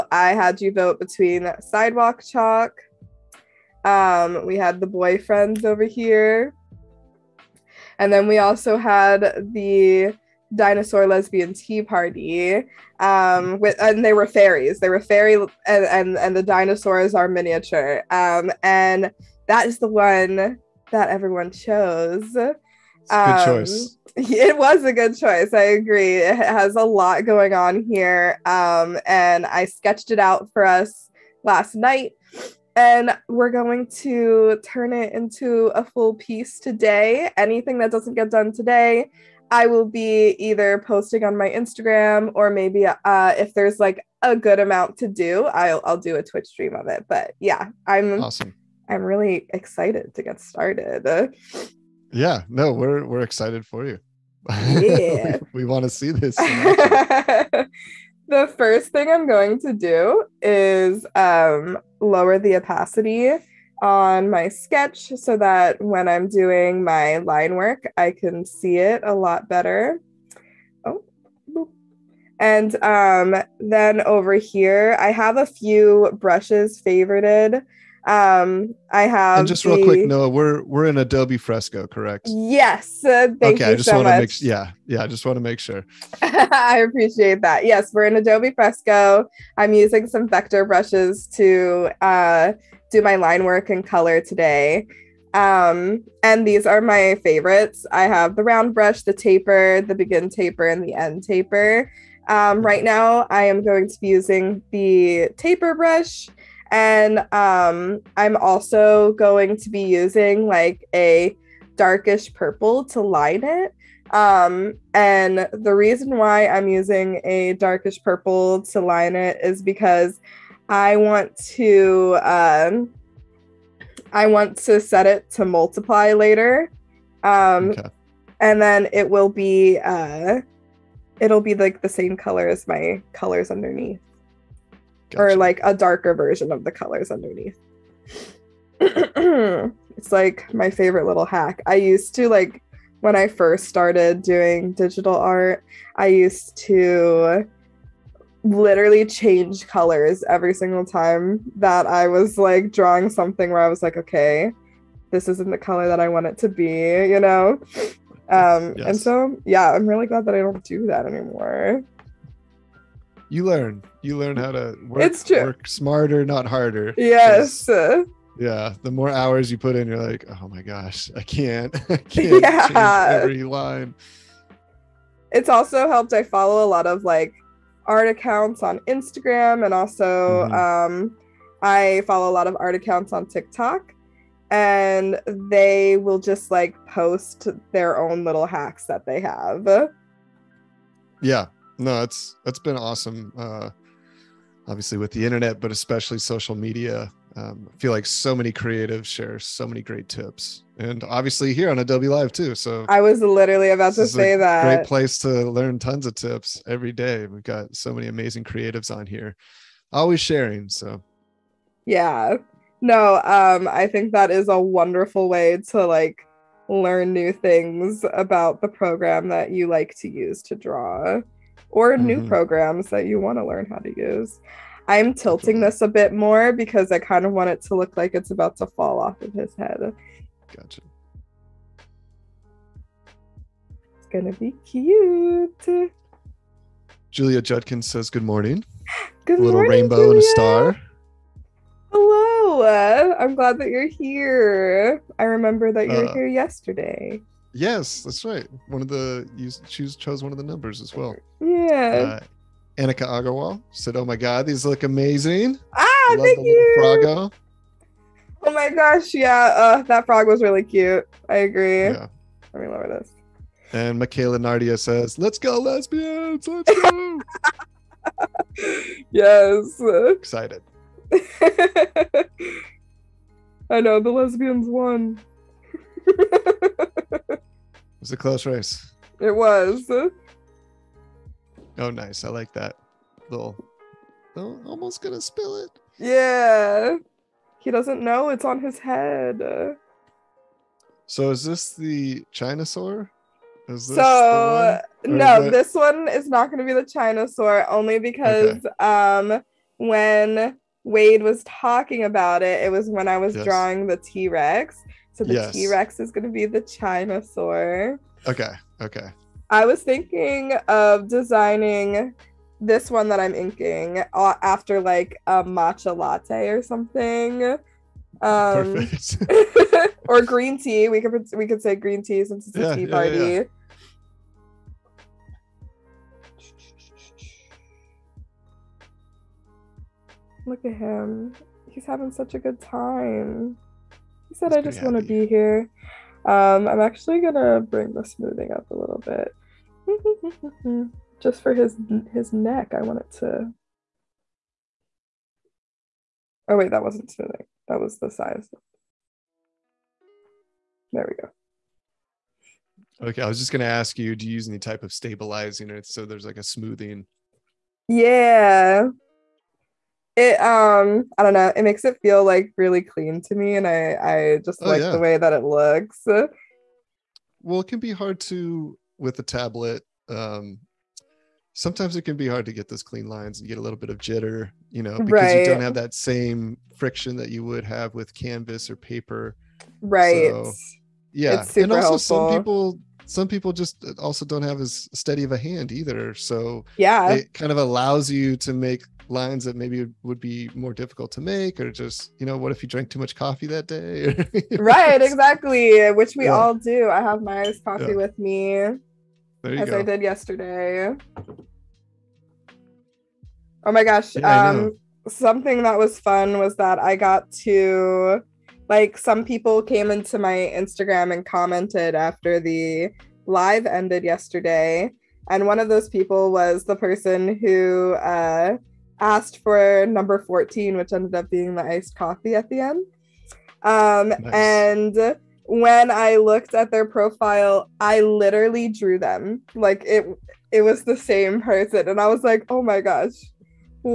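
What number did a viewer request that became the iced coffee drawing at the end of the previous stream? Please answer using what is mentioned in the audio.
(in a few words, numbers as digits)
14.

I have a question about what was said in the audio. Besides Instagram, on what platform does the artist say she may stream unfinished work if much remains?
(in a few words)
Twitch.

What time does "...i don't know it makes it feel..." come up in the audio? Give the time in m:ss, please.
6:01.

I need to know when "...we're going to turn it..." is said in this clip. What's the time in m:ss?
0:33.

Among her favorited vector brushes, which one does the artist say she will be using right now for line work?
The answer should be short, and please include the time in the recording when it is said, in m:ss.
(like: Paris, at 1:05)
taper brush, at 1:45.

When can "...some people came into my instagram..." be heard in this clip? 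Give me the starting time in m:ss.
6:48.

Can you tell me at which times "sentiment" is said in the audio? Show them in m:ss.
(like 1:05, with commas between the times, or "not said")
not said.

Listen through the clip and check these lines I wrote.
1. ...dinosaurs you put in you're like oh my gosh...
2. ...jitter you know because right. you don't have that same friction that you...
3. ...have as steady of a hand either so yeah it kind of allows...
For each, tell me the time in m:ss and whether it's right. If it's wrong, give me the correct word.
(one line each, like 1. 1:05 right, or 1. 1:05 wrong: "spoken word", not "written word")
1. 2:49 wrong: "hours", not "dinosaurs"
2. 6:13 right
3. 6:24 right.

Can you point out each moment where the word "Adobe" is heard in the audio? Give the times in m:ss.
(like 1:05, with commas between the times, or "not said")
1:20, 1:28, 3:21.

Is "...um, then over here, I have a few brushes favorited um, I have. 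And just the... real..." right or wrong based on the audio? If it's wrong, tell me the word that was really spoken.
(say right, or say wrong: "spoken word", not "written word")
right.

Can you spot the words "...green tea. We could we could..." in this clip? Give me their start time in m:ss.
5:20.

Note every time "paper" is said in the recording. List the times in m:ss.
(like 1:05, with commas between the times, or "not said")
6:18.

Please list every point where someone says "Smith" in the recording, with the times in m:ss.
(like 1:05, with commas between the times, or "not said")
not said.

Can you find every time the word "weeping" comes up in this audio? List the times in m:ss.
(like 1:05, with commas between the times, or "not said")
not said.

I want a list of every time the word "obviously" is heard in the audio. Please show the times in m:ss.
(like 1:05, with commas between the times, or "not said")
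3:14, 3:21.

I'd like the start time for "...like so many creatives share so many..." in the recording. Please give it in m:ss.
3:17.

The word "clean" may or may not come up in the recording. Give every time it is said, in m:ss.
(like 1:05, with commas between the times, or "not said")
6:02, 6:12.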